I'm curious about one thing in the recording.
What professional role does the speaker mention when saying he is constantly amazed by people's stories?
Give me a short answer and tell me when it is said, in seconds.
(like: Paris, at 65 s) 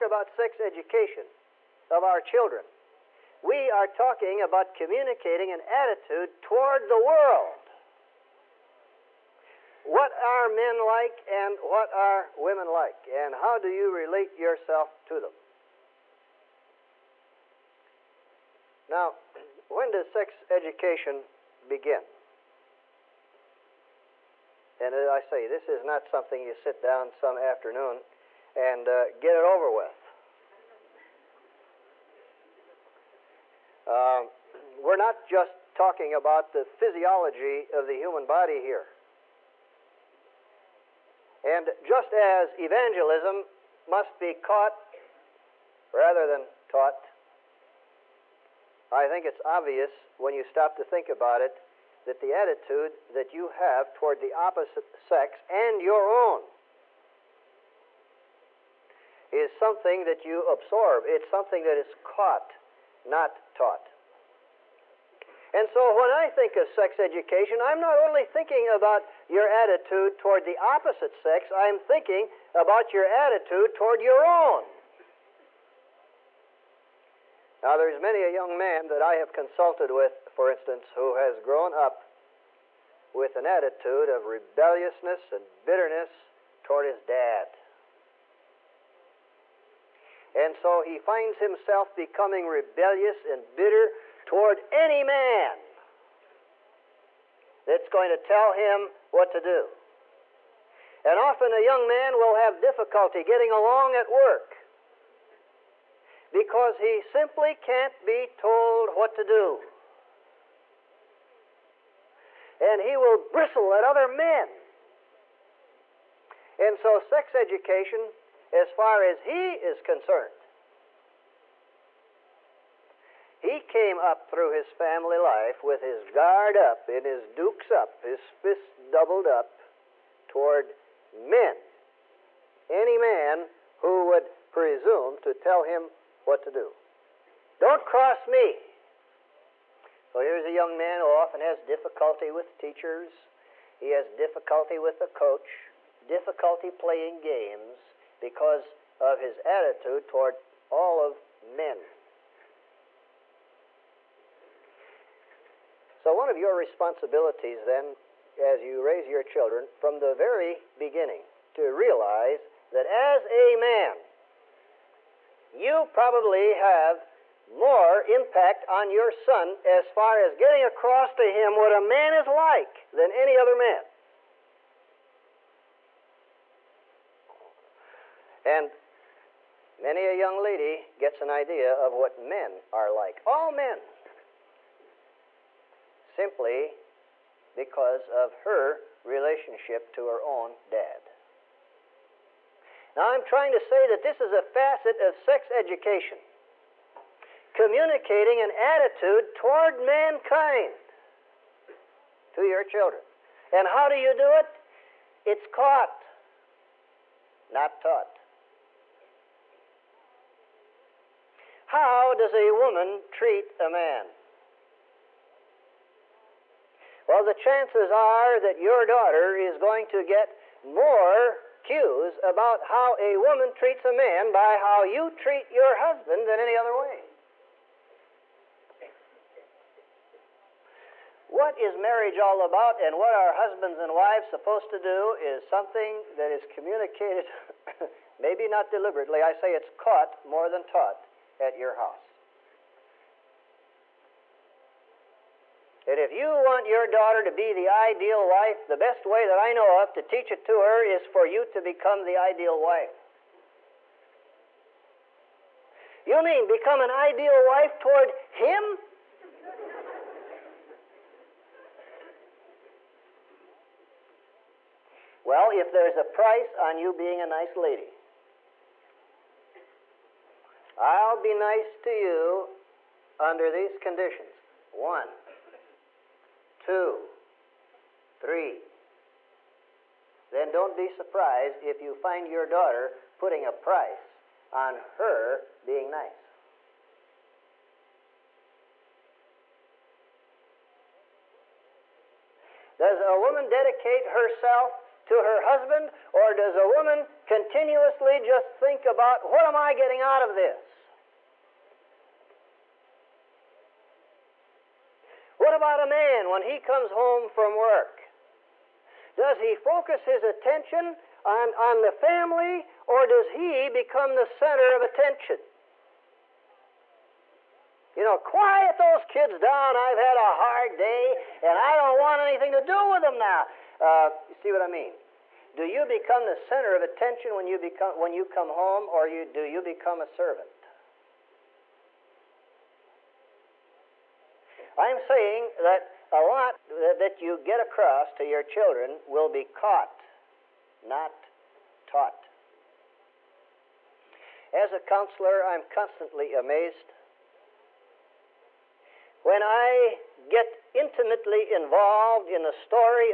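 A counselor, at 344 s.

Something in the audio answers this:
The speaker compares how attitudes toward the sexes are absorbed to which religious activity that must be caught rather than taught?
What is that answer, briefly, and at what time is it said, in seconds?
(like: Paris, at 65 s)
Evangelism, at 42 s.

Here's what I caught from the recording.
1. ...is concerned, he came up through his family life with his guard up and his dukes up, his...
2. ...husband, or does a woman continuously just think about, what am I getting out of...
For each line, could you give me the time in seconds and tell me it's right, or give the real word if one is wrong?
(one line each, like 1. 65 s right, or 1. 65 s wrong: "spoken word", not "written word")
1. 119 s right
2. 295 s right.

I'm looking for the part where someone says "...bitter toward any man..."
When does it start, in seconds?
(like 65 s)
93 s.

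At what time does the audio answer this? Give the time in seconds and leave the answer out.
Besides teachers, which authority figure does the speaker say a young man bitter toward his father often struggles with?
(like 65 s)
144 s.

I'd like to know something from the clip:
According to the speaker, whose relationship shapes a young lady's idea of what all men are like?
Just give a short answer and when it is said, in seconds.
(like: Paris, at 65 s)
Her own dad, at 190 s.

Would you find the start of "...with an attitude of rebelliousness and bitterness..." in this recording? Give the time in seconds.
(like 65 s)
83 s.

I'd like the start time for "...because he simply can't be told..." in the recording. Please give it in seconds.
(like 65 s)
106 s.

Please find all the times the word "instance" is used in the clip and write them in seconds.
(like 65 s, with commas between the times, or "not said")
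80 s.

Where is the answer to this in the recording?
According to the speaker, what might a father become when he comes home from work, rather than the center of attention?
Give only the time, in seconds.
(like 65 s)
330 s.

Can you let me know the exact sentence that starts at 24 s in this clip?
And as uh, I say, this is not something you sit down some afternoon and uh, get it over with.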